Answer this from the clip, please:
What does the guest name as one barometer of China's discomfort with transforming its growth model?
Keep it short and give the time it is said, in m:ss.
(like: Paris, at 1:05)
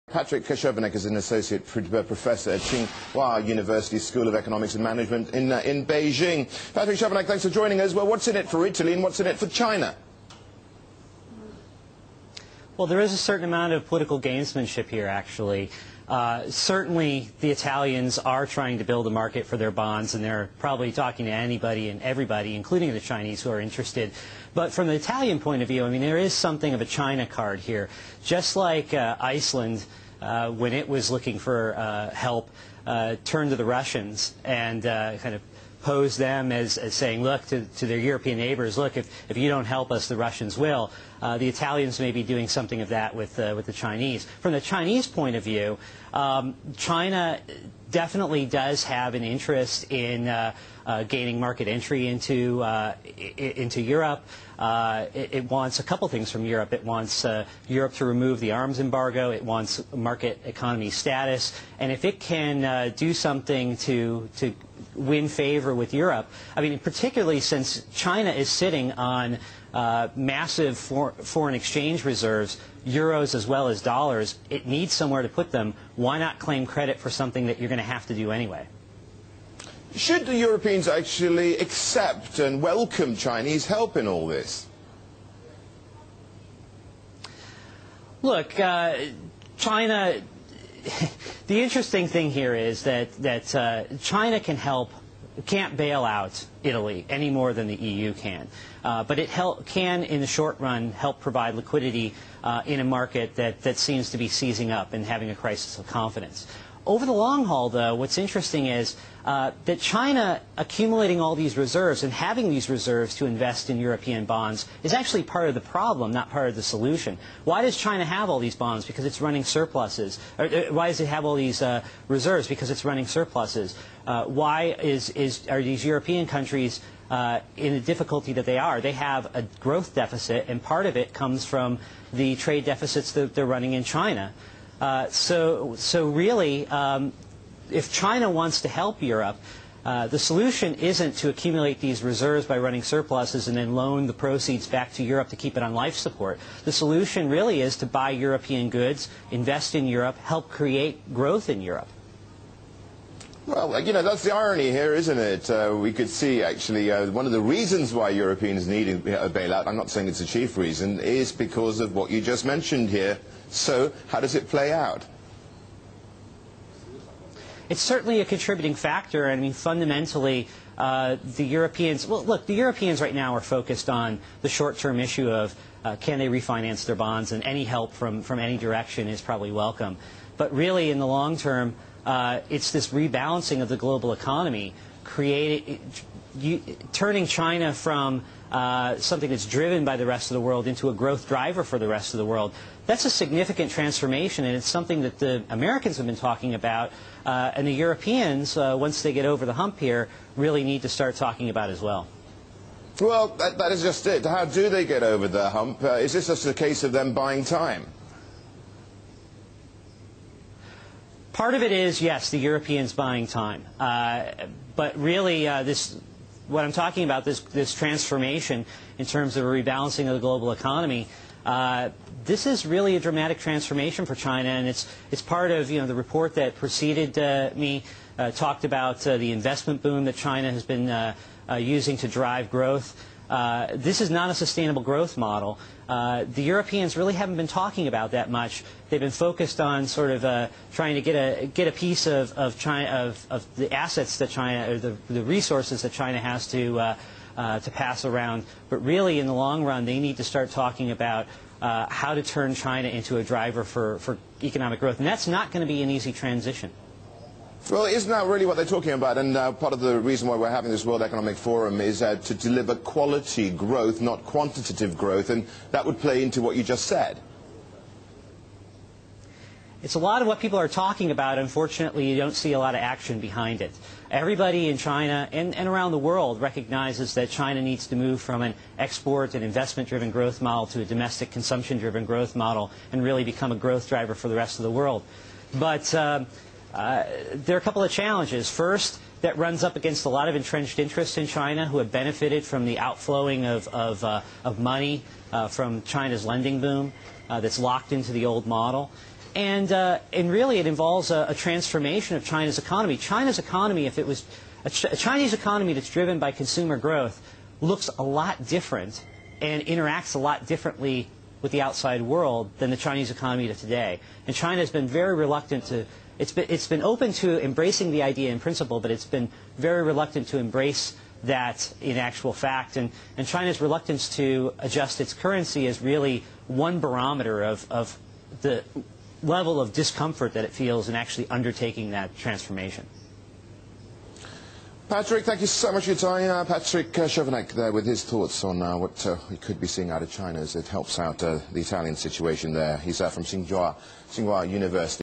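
Reluctance to adjust its currency, at 5:23.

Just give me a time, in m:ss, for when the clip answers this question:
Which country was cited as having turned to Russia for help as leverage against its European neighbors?
0:29.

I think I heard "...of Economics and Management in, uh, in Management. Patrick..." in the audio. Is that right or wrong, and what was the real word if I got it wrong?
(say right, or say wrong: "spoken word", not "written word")
wrong: "Beijing", not "Management".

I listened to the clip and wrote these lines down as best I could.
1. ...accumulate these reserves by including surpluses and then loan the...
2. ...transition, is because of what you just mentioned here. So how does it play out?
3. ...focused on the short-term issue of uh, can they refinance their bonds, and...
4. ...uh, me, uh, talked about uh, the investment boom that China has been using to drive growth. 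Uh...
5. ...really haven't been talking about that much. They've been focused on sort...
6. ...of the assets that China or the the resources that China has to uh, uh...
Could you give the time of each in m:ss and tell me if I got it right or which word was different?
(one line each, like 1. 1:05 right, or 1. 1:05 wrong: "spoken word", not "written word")
1. 2:21 wrong: "running", not "including"
2. 2:40 wrong: "reason", not "transition"
3. 2:53 right
4. 3:47 right
5. 3:56 right
6. 4:03 right.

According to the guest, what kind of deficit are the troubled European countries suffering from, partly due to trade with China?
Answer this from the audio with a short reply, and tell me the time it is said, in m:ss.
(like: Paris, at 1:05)
A growth deficit, at 2:09.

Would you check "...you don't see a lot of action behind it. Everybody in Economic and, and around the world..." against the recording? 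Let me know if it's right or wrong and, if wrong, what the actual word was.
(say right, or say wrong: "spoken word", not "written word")
wrong: "China", not "Economic".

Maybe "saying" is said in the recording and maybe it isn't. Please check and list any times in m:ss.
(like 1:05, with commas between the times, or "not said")
0:36, 2:39.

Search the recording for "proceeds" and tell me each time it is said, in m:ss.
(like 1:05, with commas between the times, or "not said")
2:24.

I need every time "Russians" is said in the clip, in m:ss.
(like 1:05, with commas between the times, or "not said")
0:33, 0:40.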